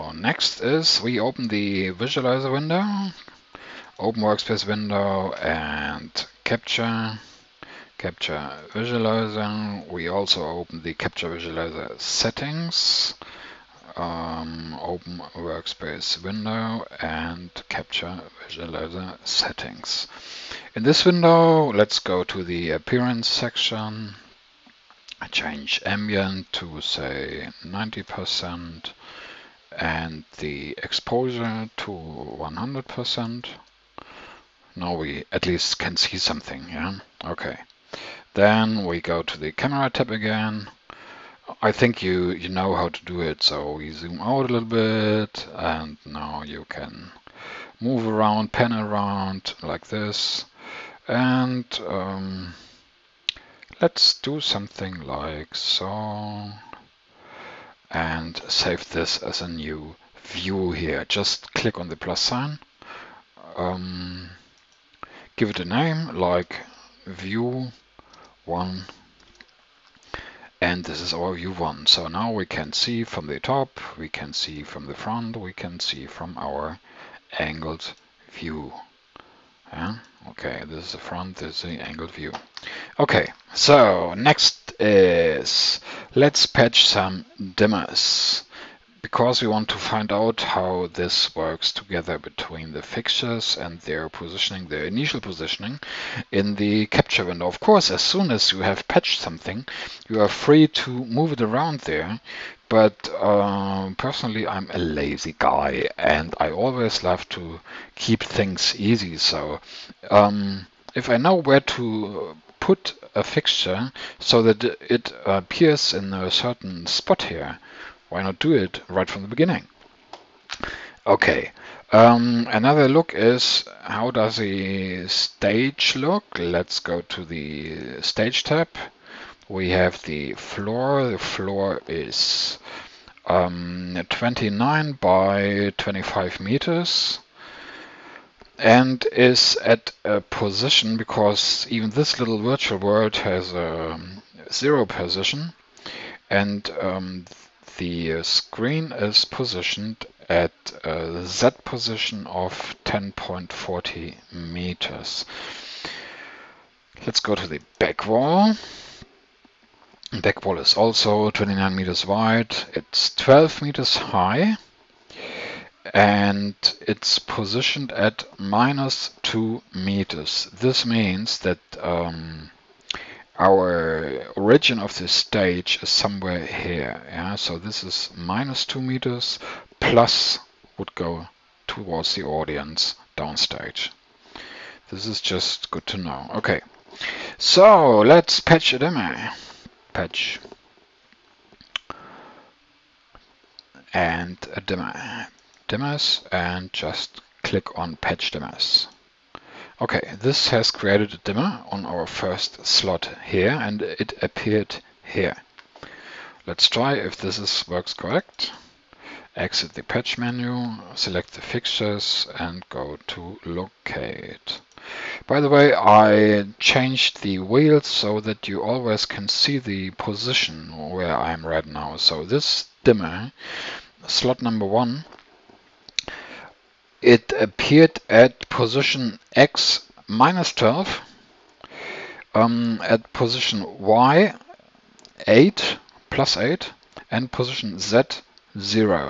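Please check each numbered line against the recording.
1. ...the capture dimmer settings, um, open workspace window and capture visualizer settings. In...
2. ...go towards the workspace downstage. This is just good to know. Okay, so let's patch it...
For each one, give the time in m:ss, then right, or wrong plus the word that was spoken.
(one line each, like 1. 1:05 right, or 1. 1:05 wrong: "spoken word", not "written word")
1. 0:10 wrong: "visualizer", not "dimmer"
2. 3:00 wrong: "audience", not "workspace".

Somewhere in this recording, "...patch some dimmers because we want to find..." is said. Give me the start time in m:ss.
1:26.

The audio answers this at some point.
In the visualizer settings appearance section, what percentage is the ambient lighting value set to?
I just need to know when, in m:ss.
0:27.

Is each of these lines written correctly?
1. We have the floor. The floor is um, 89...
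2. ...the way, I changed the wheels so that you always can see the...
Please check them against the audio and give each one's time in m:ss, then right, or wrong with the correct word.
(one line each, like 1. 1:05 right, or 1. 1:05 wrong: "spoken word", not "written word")
1. 2:09 wrong: "29", not "89"
2. 3:35 right.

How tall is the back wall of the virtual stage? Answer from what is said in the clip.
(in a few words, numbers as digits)
12 meters.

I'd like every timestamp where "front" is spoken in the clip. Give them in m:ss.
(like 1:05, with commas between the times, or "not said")
1:14, 1:20.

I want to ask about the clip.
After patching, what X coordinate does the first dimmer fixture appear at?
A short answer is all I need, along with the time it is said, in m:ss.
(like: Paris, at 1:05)
-12, at 3:50.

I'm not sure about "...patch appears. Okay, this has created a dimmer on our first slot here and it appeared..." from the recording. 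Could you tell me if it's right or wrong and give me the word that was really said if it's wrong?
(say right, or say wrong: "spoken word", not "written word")
wrong: "dimmers", not "appears".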